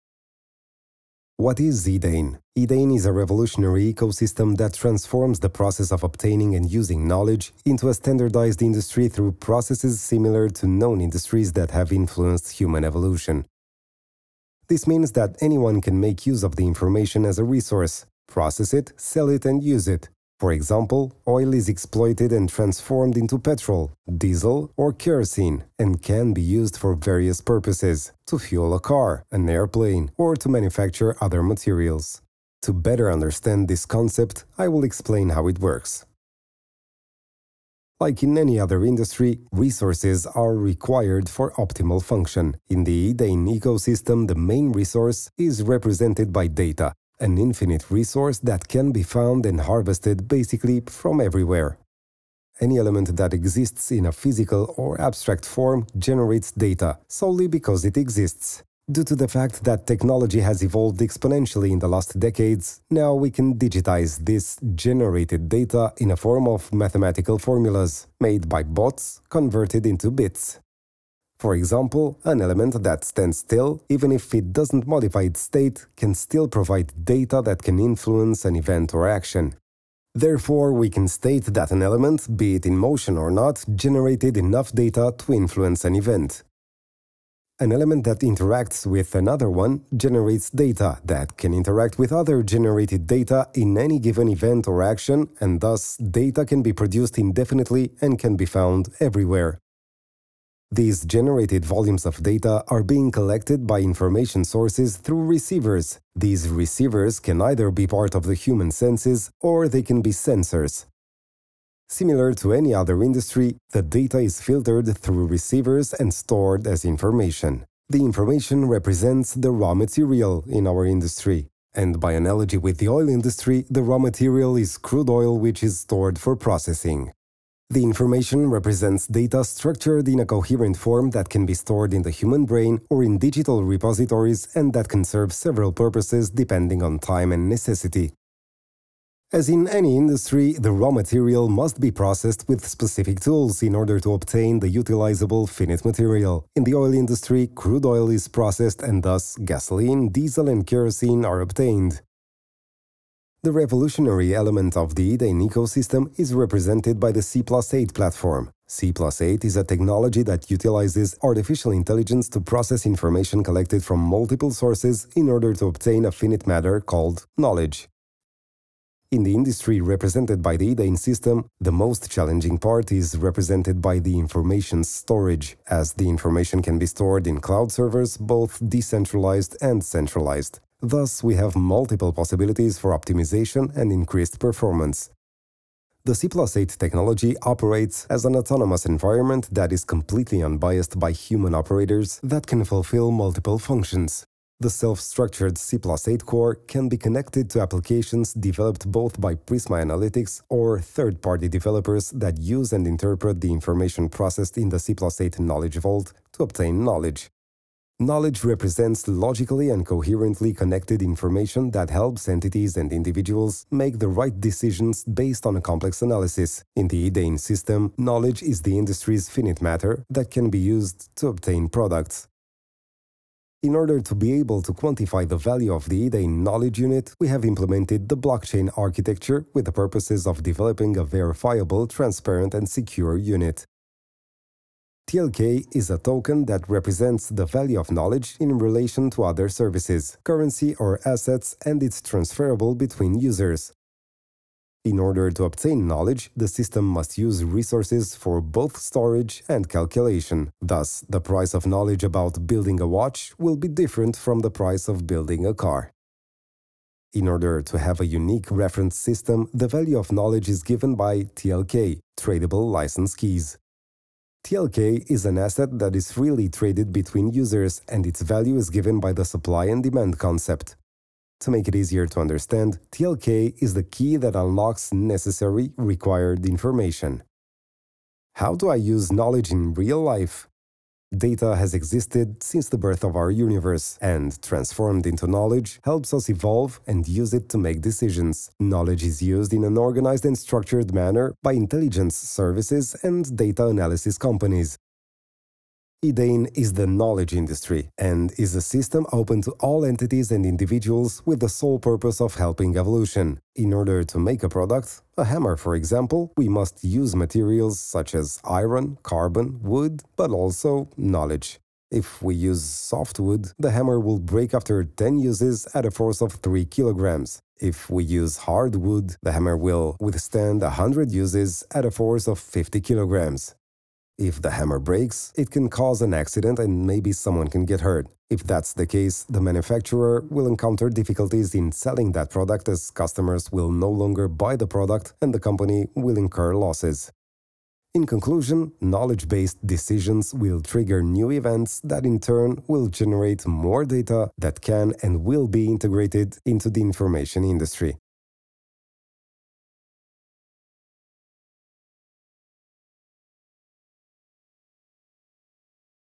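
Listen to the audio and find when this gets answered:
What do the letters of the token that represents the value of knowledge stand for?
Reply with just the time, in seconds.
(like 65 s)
262 s.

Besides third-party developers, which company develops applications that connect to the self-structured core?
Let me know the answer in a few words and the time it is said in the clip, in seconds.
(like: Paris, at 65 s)
Prisma Analytics, at 199 s.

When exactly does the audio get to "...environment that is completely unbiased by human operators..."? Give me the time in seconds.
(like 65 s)
188 s.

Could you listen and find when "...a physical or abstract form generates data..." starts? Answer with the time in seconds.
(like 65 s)
54 s.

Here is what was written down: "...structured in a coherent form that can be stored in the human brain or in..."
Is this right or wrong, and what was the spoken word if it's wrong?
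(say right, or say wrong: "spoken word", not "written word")
right.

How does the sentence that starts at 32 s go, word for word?
To better understand this concept, I will explain how it works.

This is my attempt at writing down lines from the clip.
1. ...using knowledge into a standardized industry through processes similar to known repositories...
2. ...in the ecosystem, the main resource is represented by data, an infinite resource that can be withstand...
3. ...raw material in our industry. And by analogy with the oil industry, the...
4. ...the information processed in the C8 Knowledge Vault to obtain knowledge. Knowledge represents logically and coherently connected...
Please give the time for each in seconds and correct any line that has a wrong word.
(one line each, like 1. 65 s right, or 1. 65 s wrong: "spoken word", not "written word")
1. 6 s wrong: "industries", not "repositories"
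2. 43 s wrong: "found", not "withstand"
3. 119 s right
4. 203 s right.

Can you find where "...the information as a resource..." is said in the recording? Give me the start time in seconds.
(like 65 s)
16 s.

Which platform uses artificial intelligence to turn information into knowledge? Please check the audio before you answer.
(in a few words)
C8.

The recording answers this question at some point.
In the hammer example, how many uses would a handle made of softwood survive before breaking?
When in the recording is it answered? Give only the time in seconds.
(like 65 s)
314 s.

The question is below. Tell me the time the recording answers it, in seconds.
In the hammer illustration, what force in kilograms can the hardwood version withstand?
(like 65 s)
322 s.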